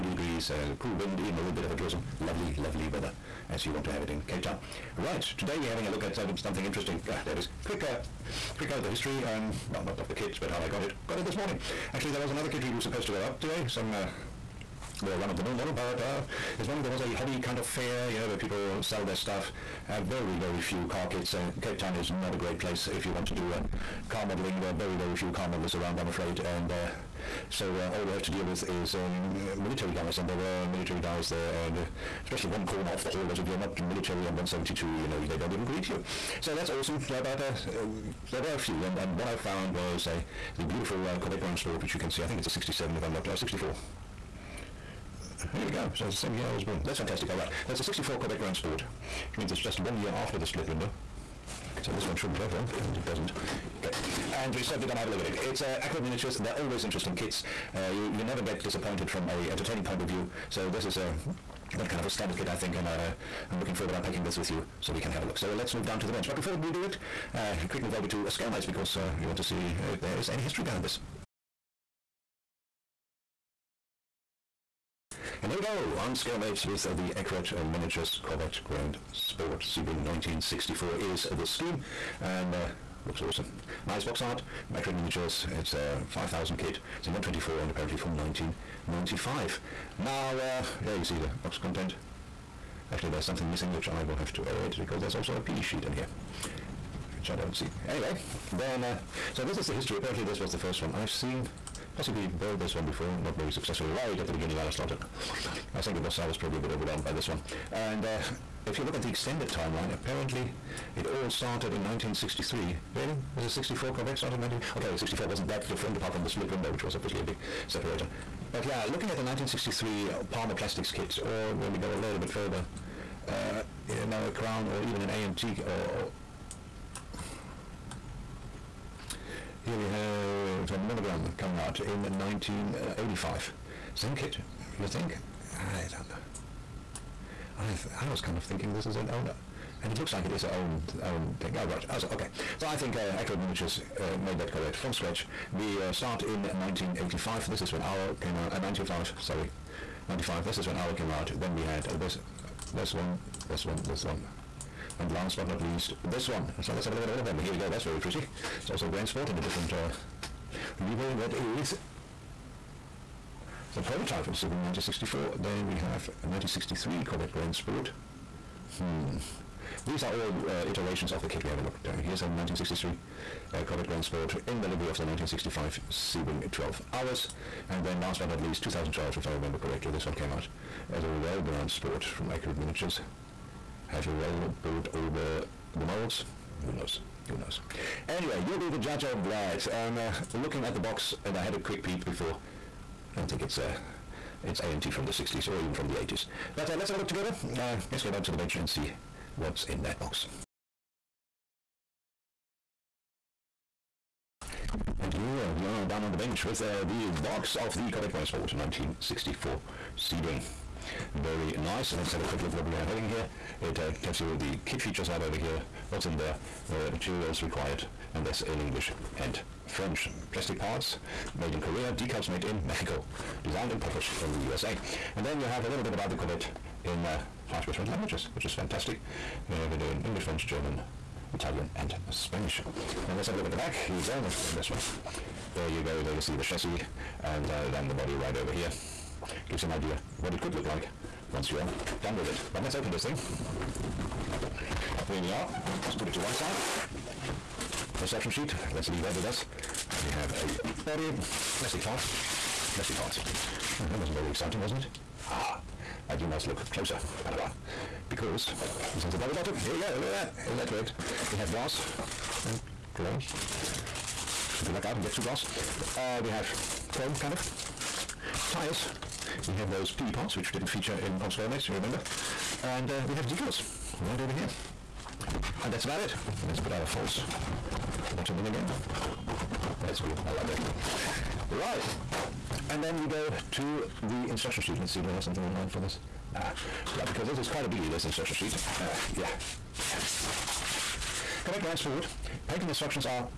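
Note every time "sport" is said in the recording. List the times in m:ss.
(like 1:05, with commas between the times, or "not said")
0:41, 0:48, 2:39, 2:47, 2:54, 3:01, 3:28, 4:51.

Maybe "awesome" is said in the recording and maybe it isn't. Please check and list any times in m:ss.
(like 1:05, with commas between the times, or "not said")
0:36, 1:23.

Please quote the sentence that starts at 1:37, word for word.
Anyway, then, uh, so this is the history.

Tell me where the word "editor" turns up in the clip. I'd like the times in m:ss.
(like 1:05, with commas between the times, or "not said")
not said.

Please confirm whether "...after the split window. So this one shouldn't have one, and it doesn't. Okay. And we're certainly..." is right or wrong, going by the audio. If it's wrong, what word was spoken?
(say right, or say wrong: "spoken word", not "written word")
right.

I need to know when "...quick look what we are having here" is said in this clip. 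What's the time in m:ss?
3:32.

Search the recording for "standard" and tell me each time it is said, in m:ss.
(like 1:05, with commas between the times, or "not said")
1:02.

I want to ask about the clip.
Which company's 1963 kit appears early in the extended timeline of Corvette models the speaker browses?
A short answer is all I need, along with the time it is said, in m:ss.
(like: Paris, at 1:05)
Palmer Plastics, at 2:00.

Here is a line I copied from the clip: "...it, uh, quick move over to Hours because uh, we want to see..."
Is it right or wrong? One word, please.
wrong.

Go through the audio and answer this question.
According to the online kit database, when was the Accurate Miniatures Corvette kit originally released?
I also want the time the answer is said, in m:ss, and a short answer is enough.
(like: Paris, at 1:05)
1995, at 1:28.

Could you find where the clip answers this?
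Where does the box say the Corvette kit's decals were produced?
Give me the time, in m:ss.
3:41.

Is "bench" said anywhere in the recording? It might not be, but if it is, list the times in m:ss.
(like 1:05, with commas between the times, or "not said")
1:06, 3:18, 3:26.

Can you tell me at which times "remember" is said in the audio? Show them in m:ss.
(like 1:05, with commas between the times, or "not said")
2:59, 4:31.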